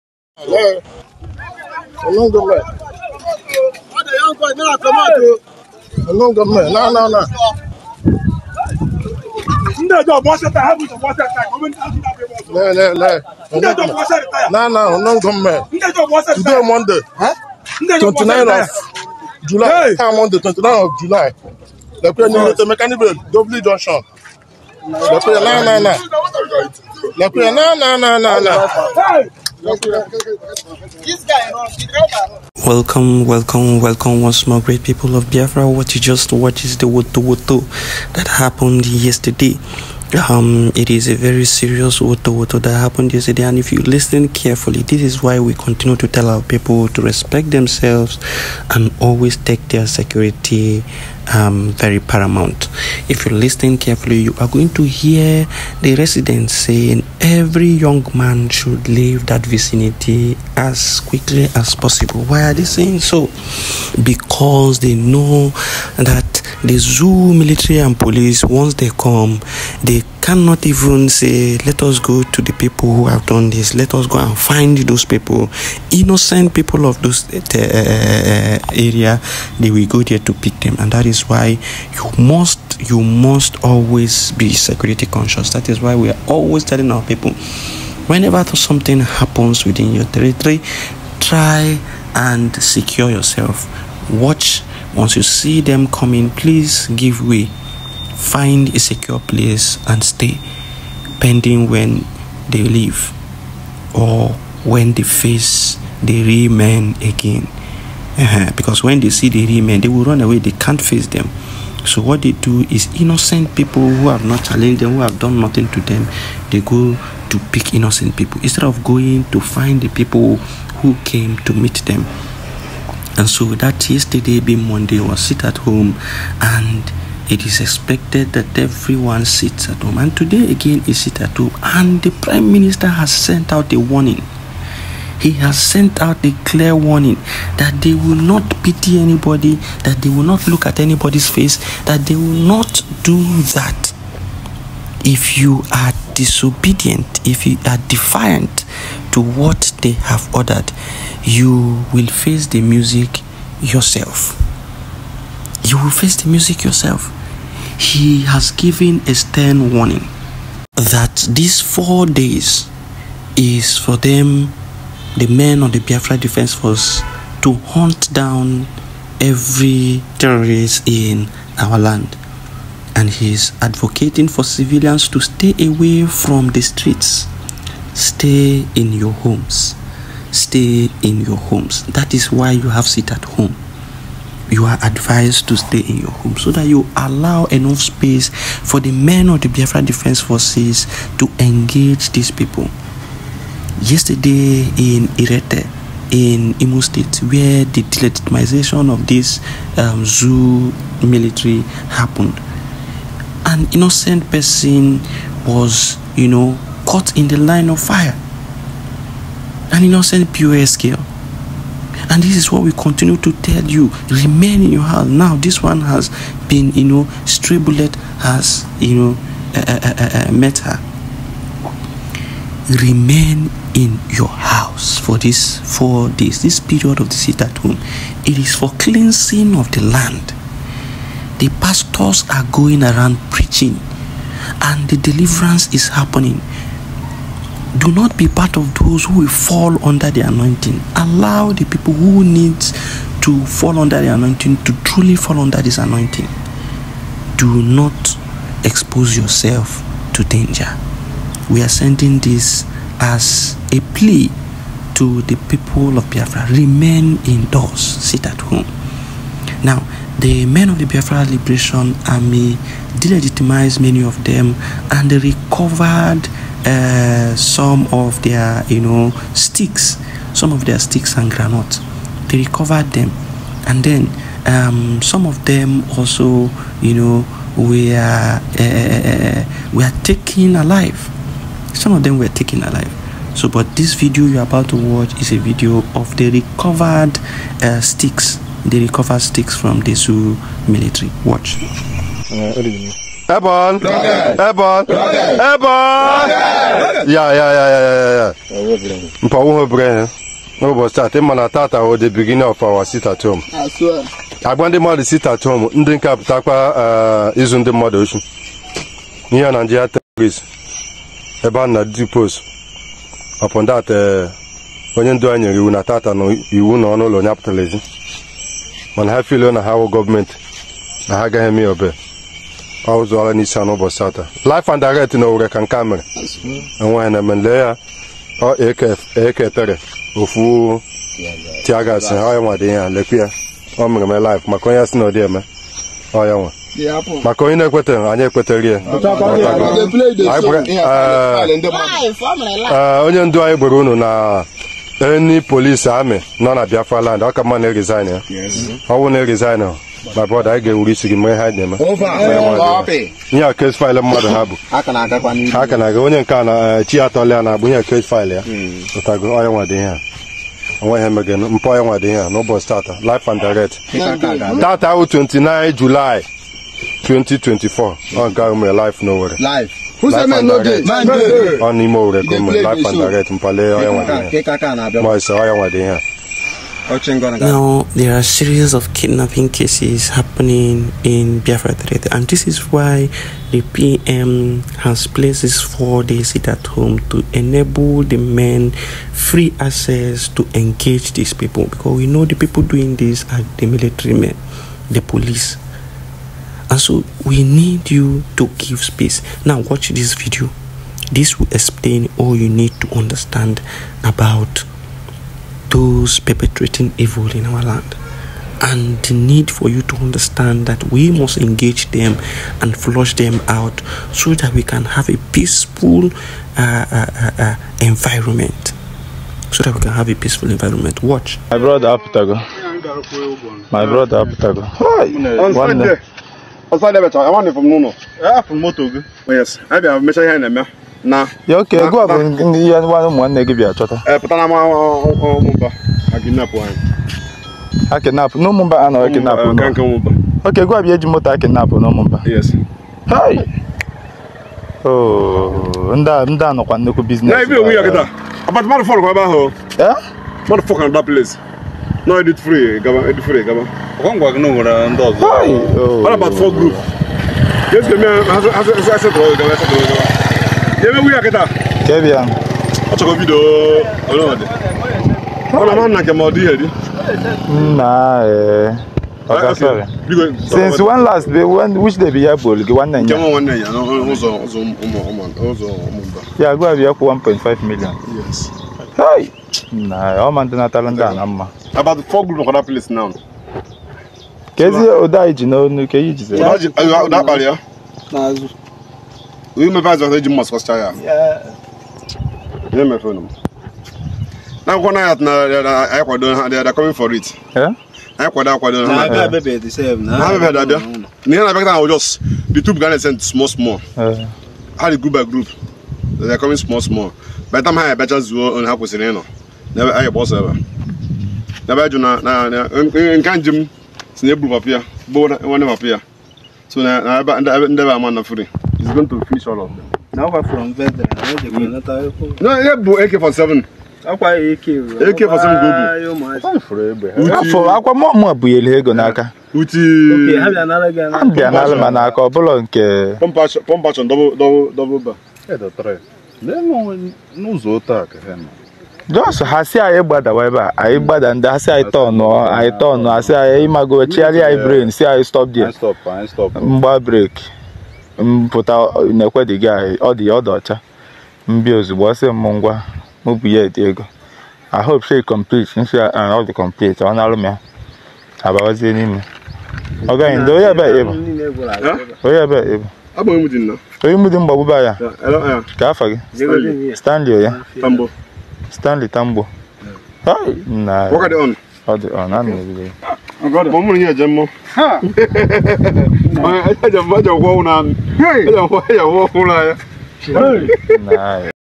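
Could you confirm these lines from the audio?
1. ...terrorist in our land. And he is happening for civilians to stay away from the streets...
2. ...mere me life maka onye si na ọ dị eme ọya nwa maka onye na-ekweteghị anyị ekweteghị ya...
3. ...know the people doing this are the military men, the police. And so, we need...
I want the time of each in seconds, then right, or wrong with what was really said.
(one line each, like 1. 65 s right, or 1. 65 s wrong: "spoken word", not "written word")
1. 170 s wrong: "advocating", not "happening"
2. 333 s right
3. 392 s right.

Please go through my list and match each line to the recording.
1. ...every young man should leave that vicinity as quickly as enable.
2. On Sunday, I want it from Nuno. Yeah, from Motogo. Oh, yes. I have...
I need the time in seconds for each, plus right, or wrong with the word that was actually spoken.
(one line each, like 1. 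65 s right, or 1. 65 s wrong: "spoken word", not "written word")
1. 57 s wrong: "possible", not "enable"
2. 426 s right.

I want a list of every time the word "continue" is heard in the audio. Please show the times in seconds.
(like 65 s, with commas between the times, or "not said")
45 s, 212 s.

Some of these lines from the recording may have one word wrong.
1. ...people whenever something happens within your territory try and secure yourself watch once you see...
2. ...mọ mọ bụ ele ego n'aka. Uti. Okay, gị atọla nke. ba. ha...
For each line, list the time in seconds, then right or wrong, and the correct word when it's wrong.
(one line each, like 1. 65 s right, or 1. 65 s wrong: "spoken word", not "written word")
1. 87 s right
2. 527 s wrong: "ọbụla", not "atọla".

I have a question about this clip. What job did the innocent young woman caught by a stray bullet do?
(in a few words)
POS girl.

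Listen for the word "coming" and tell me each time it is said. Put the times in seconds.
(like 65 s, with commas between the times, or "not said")
95 s.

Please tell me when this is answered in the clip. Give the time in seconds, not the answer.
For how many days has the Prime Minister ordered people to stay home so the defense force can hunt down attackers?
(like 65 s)
161 s.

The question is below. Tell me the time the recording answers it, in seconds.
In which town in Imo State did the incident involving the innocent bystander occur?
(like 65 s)
195 s.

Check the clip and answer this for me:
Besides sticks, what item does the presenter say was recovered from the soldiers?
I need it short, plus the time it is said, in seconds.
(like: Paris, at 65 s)
granite, at 271 s.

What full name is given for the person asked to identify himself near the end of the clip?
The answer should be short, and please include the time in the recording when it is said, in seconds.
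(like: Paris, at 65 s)
Stanley Tambo, at 568 s.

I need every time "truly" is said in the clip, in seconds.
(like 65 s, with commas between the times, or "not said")
244 s.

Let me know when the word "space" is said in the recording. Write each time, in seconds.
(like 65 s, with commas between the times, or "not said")
187 s, 398 s.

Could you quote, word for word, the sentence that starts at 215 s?
Now, this one has been, you know, stray bullet has, you know, uh uh, uh, uh, uh, met her.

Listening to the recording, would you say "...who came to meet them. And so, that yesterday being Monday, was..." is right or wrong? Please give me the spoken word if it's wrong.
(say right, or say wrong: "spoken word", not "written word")
right.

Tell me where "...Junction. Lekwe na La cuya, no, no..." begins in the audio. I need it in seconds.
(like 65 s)
23 s.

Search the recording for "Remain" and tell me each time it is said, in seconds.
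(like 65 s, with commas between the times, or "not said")
214 s, 222 s, 256 s.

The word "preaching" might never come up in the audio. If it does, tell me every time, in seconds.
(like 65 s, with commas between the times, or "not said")
233 s.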